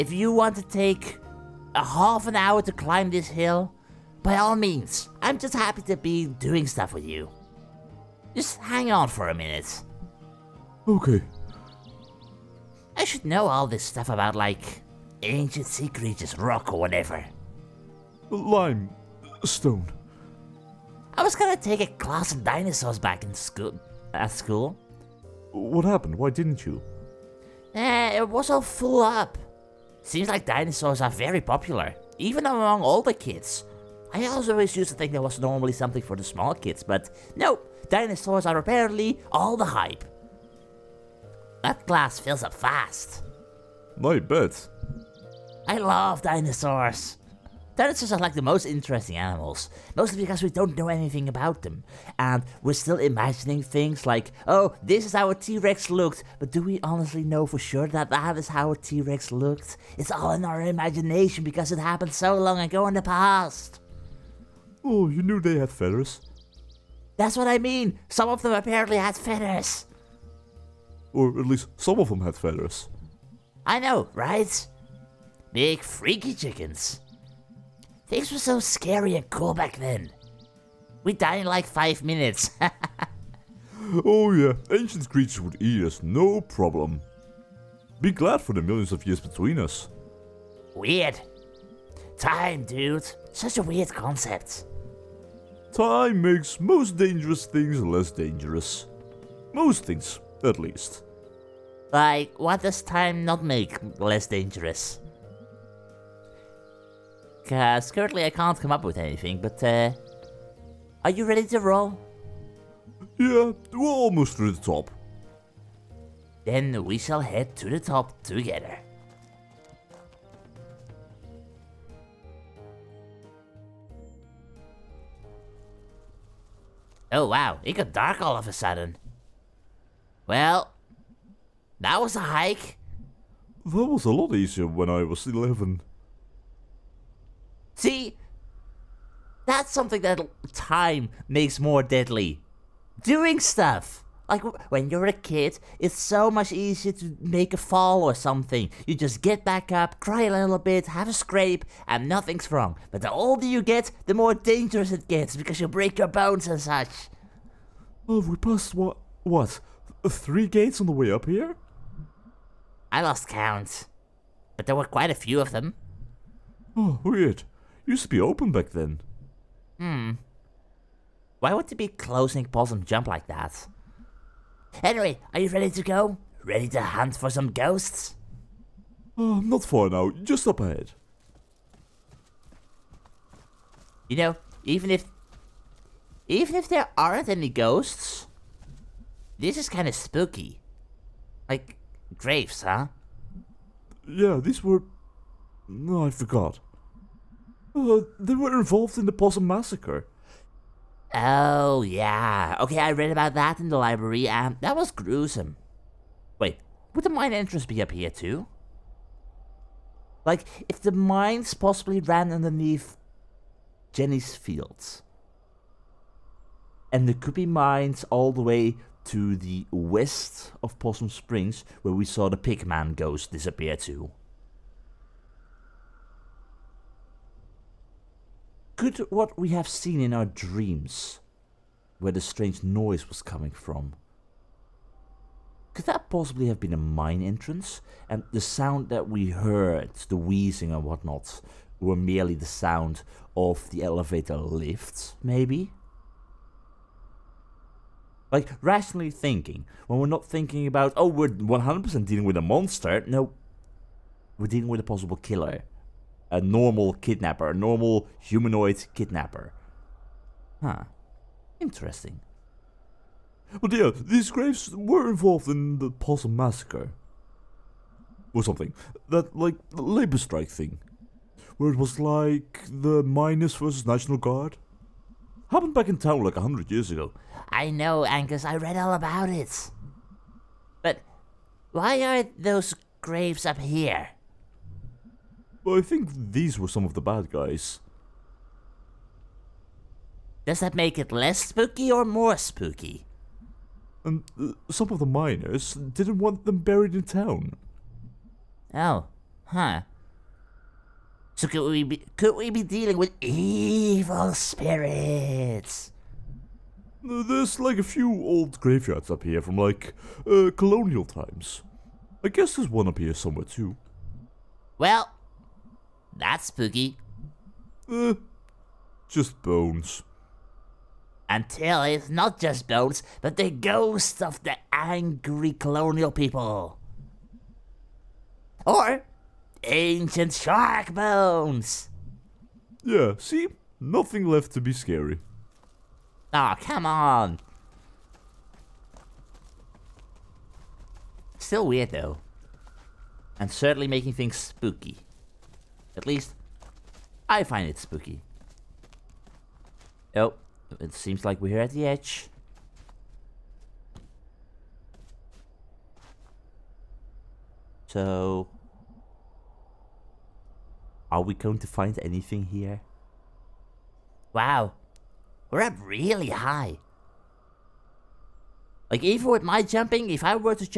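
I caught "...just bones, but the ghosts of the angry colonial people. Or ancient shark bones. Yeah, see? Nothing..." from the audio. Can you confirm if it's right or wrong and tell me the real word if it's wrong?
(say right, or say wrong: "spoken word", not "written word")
right.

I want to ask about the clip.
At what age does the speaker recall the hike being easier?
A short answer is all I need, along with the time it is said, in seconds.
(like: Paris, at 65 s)
11, at 135 s.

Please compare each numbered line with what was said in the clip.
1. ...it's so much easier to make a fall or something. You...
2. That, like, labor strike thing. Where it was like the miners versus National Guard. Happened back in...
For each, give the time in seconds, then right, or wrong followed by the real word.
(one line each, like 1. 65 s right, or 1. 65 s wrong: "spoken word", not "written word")
1. 145 s right
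2. 269 s right.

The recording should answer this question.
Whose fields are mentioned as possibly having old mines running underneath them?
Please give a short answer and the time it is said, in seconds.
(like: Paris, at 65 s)
Jenny's fields, at 213 s.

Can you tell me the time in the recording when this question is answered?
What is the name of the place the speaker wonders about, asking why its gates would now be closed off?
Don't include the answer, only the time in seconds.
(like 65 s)
172 s.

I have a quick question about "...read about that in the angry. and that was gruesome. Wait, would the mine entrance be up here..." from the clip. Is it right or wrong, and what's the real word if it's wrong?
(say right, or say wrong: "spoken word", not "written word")
wrong: "library", not "angry".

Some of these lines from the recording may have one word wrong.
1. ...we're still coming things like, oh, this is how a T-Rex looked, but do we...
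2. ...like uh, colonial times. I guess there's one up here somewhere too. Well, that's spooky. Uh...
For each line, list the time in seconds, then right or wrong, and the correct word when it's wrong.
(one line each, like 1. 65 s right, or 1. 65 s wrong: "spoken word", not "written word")
1. 52 s wrong: "imagining", not "coming"
2. 309 s right.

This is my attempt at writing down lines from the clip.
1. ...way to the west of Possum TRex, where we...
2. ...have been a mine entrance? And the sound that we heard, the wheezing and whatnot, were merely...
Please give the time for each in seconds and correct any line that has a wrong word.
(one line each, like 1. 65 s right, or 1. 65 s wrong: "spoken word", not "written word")
1. 218 s wrong: "Springs", not "TRex"
2. 236 s right.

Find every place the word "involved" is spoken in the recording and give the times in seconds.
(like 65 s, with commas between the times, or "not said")
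198 s, 265 s.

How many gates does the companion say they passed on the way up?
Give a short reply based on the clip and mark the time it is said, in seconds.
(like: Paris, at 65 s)
3, at 160 s.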